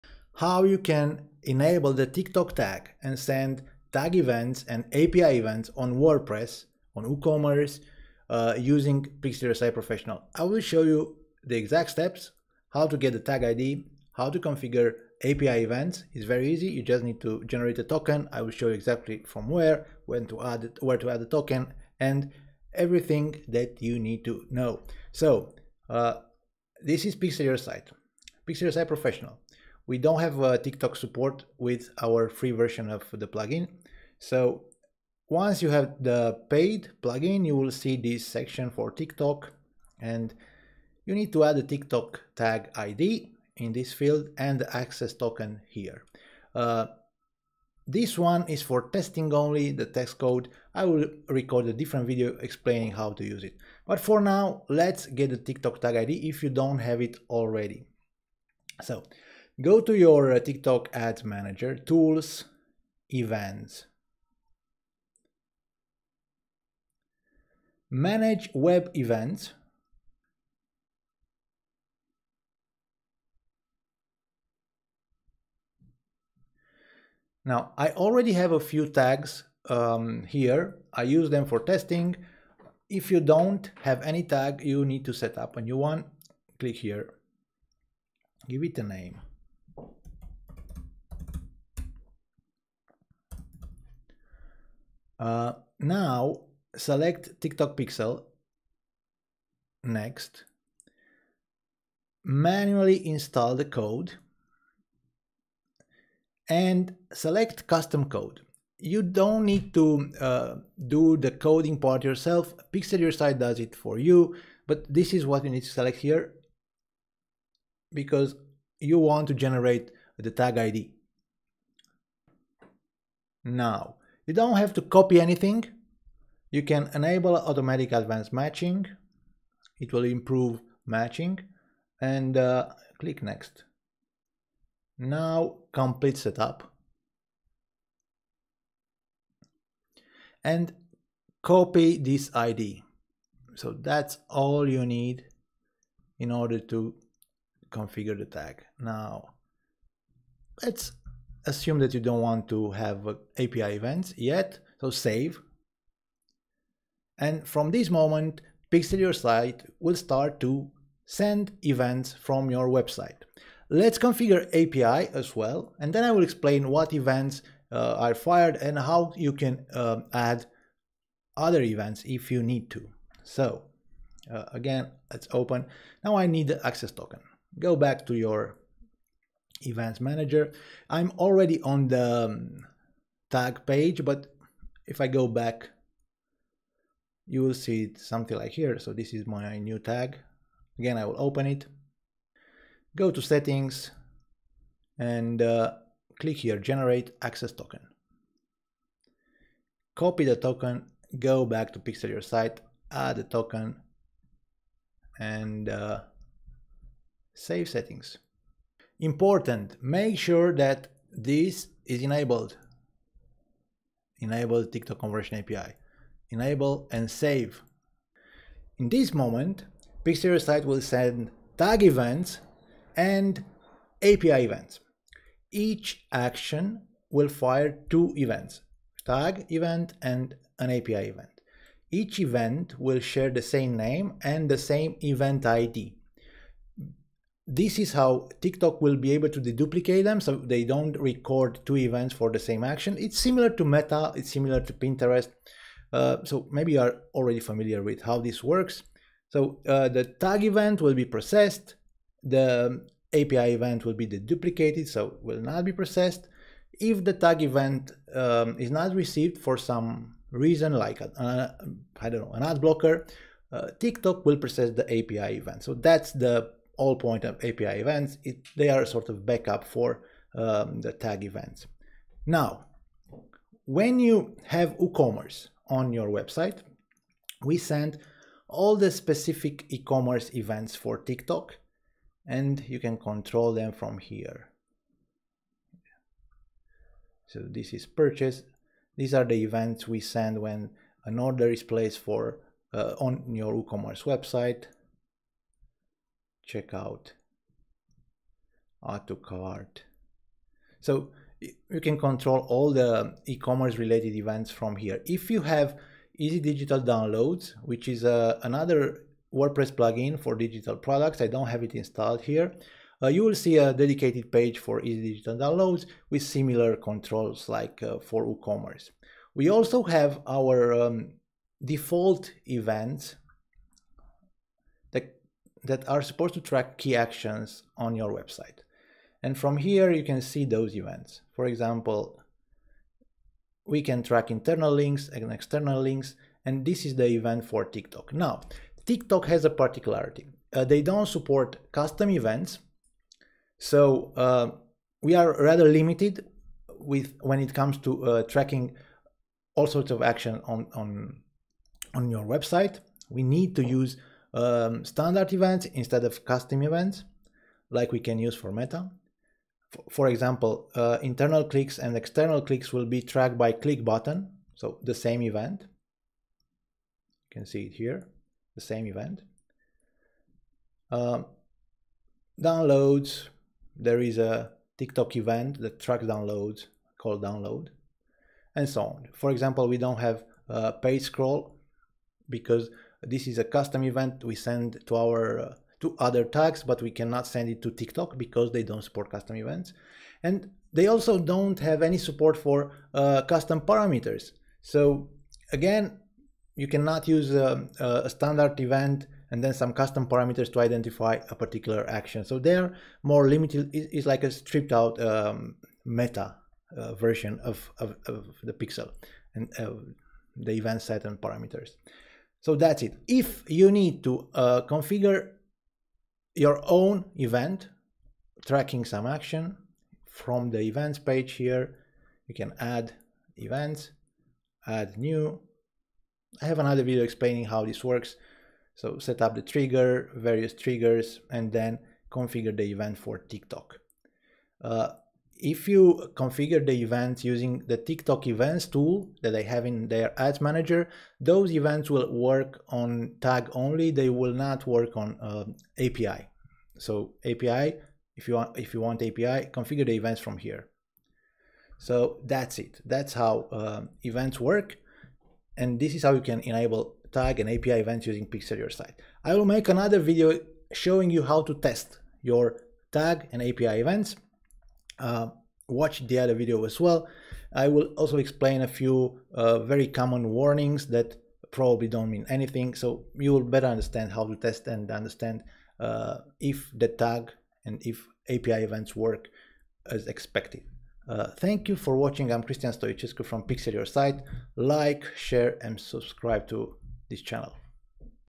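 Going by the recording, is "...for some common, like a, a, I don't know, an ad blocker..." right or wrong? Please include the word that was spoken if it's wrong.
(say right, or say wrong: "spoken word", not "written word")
wrong: "reason", not "common".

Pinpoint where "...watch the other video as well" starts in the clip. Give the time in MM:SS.
07:45.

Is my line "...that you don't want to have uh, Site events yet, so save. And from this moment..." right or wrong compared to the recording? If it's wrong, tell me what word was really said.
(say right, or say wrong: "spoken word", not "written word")
wrong: "API", not "Site".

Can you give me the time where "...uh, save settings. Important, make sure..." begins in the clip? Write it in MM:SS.
03:25.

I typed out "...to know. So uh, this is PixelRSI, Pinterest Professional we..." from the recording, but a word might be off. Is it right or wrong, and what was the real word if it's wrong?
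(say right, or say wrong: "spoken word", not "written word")
wrong: "Site", not "Pinterest".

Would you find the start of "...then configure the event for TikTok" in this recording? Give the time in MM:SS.
07:11.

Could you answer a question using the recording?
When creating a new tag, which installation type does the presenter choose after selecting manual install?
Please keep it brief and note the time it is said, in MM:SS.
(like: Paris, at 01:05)
Custom code, at 01:47.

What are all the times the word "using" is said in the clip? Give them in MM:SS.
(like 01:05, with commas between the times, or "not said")
00:08, 07:17, 07:38.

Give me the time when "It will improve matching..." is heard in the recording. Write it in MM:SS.
02:09.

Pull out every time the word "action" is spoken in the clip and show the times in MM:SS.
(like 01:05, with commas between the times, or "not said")
03:46, 04:02, 05:26, 05:50, 06:41, 06:59.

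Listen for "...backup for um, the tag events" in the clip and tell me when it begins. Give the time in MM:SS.
04:29.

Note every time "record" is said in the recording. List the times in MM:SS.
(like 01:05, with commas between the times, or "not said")
00:51, 04:00.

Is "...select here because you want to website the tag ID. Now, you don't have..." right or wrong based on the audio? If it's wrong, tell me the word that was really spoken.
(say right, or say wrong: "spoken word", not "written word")
wrong: "generate", not "website".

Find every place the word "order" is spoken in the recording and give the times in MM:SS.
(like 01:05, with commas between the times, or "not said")
02:26, 04:51.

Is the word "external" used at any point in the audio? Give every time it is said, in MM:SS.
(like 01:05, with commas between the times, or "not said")
05:35, 06:01.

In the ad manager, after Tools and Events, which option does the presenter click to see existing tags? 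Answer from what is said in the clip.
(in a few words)
Manage Web Events.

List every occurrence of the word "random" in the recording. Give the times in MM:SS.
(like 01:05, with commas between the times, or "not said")
not said.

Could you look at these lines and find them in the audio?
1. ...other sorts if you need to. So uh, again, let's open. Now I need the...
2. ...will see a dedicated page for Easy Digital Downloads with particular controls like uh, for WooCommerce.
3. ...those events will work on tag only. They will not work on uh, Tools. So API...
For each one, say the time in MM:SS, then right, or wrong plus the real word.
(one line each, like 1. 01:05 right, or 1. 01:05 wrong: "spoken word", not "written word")
1. 02:51 wrong: "events", not "sorts"
2. 05:13 wrong: "similar", not "particular"
3. 07:21 wrong: "API", not "Tools".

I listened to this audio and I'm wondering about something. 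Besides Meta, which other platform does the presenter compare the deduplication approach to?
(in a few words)
Pinterest.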